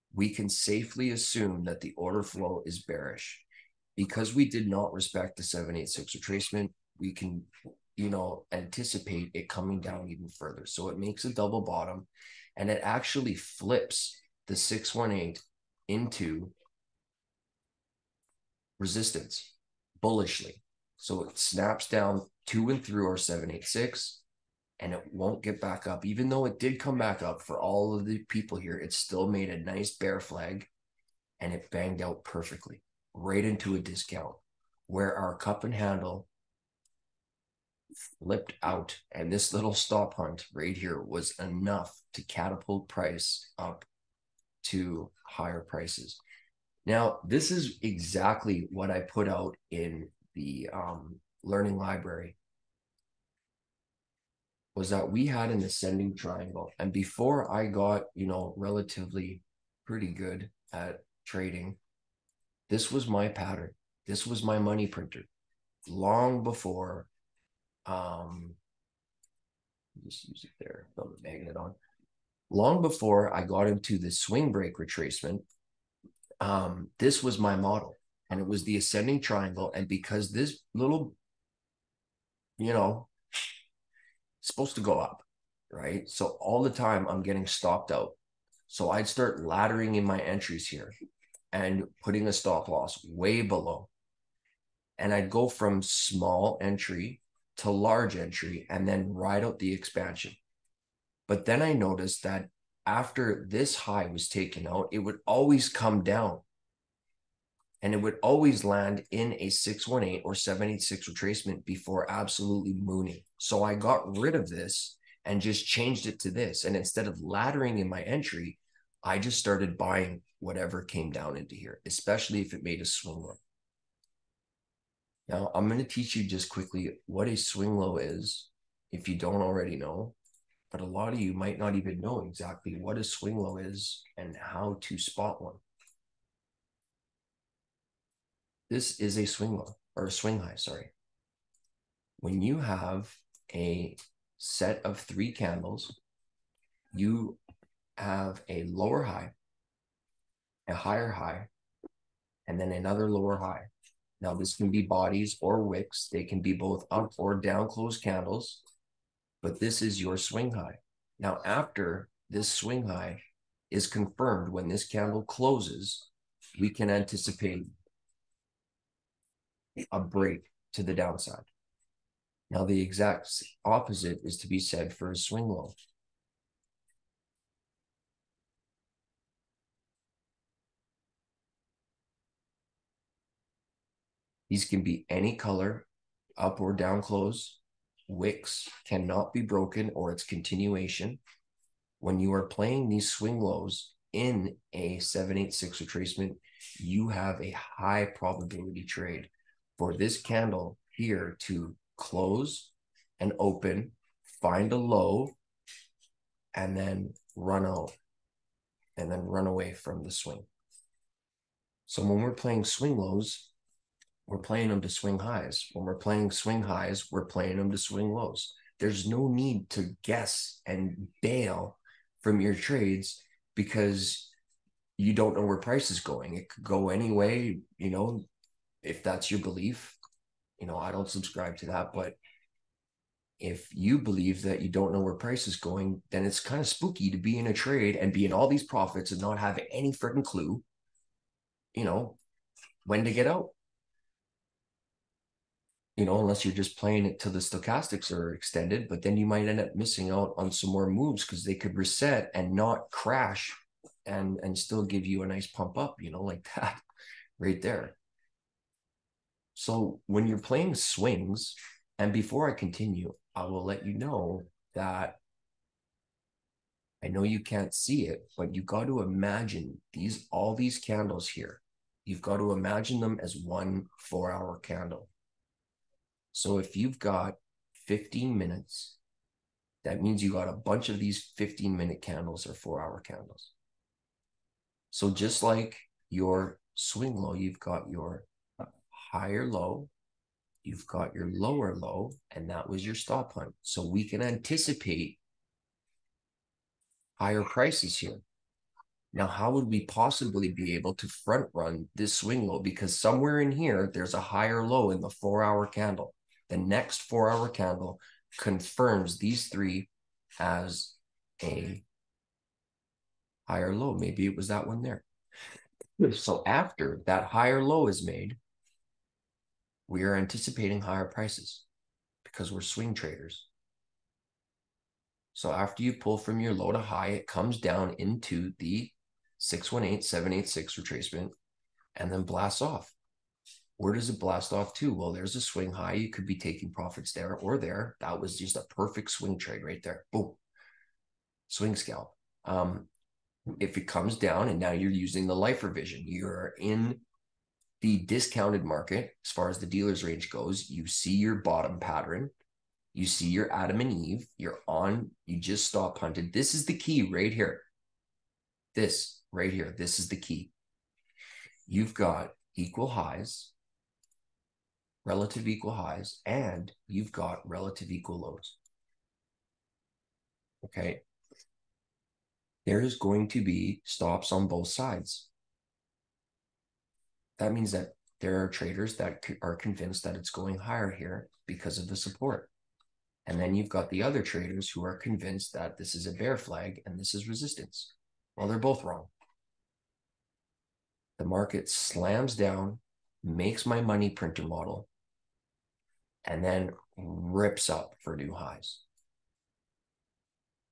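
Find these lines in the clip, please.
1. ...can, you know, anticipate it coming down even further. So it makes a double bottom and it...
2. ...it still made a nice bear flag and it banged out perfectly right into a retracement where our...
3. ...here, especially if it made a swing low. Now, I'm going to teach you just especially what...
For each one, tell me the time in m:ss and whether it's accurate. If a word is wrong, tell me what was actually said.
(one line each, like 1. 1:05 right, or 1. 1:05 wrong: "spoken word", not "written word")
1. 0:07 right
2. 0:28 wrong: "discount", not "retracement"
3. 2:01 wrong: "quickly", not "especially".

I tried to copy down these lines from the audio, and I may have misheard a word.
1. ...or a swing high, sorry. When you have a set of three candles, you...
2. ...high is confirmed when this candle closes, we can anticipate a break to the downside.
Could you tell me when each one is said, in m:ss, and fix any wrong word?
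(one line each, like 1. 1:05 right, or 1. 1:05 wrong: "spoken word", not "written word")
1. 2:19 right
2. 2:42 right.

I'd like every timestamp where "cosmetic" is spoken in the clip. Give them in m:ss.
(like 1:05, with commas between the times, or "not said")
not said.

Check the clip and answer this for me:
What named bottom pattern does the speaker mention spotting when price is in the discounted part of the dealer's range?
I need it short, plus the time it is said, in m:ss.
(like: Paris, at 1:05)
Adam and Eve, at 5:53.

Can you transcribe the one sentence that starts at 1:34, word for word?
And I'd go from small entry to large entry and then ride out the expansion.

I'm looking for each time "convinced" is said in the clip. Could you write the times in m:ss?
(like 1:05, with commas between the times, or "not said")
6:19, 6:24.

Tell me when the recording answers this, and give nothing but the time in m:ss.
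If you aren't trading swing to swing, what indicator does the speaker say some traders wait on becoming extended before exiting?
4:07.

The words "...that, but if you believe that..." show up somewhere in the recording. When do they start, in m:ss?
3:51.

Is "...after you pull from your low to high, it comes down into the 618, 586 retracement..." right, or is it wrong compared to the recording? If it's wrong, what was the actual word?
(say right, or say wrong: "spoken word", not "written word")
wrong: "786", not "586".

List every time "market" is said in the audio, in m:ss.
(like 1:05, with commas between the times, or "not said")
5:48, 6:31.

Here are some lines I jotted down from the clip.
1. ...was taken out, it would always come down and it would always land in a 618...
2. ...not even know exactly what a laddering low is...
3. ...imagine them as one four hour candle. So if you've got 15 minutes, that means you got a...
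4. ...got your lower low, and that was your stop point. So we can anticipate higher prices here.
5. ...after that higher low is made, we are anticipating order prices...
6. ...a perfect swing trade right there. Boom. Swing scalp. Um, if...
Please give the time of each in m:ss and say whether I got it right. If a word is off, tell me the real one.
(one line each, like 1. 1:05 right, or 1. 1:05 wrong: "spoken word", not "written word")
1. 1:44 right
2. 2:11 wrong: "swing", not "laddering"
3. 4:32 right
4. 4:50 right
5. 5:16 wrong: "higher", not "order"
6. 5:38 right.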